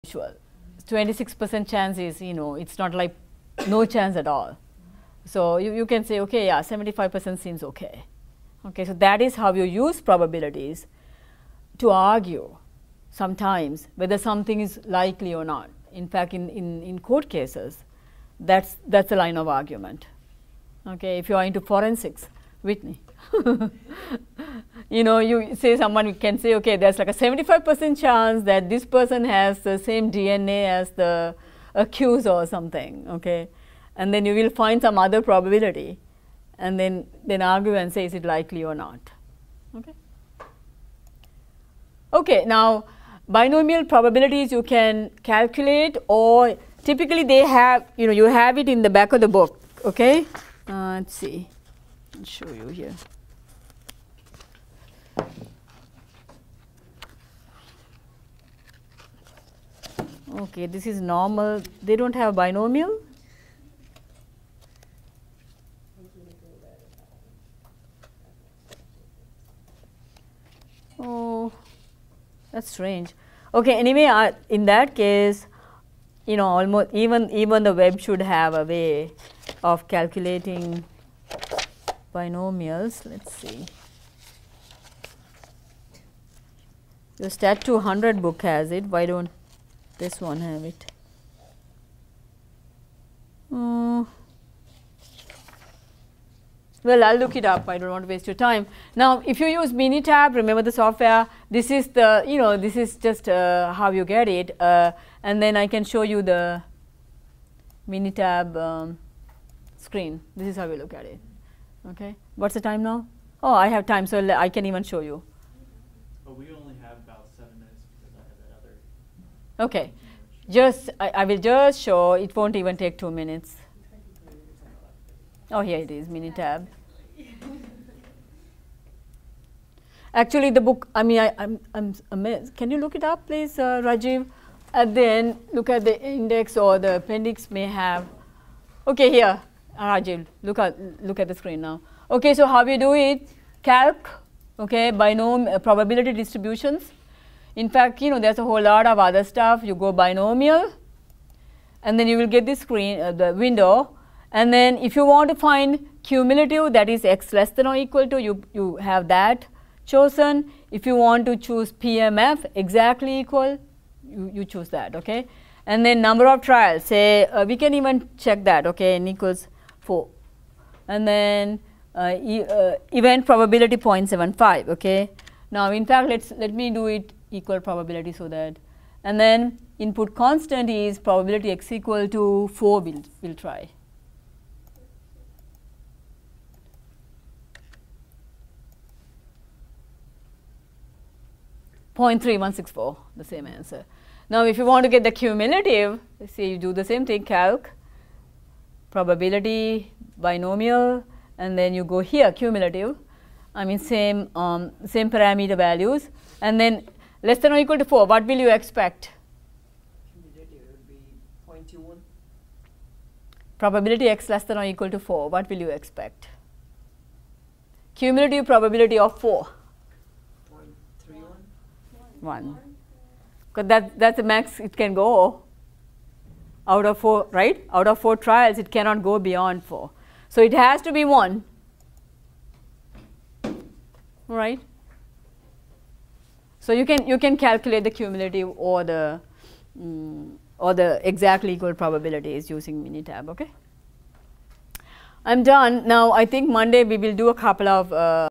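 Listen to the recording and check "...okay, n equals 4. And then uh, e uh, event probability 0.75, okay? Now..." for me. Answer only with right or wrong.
right.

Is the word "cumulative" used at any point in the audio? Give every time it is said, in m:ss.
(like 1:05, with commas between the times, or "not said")
2:36, 3:15, 3:22, 3:37, 3:57.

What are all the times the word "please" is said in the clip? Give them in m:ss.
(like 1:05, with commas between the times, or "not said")
2:13.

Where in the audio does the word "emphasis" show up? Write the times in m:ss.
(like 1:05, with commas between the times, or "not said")
not said.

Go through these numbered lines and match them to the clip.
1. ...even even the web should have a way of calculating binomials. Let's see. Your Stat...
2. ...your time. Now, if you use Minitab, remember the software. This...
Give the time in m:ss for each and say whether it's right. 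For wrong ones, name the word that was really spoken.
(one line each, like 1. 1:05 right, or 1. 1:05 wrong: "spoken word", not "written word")
1. 1:16 right
2. 1:38 right.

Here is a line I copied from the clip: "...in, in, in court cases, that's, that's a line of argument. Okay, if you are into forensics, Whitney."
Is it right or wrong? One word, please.
right.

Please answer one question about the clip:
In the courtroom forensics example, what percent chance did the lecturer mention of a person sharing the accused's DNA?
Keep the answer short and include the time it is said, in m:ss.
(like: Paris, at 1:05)
75 percent, at 0:27.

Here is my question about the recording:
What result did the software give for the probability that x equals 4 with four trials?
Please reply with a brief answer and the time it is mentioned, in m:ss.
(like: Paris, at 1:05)
0.3164, at 3:12.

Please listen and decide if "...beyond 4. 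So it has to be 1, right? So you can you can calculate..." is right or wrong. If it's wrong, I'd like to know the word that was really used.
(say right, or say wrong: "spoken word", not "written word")
right.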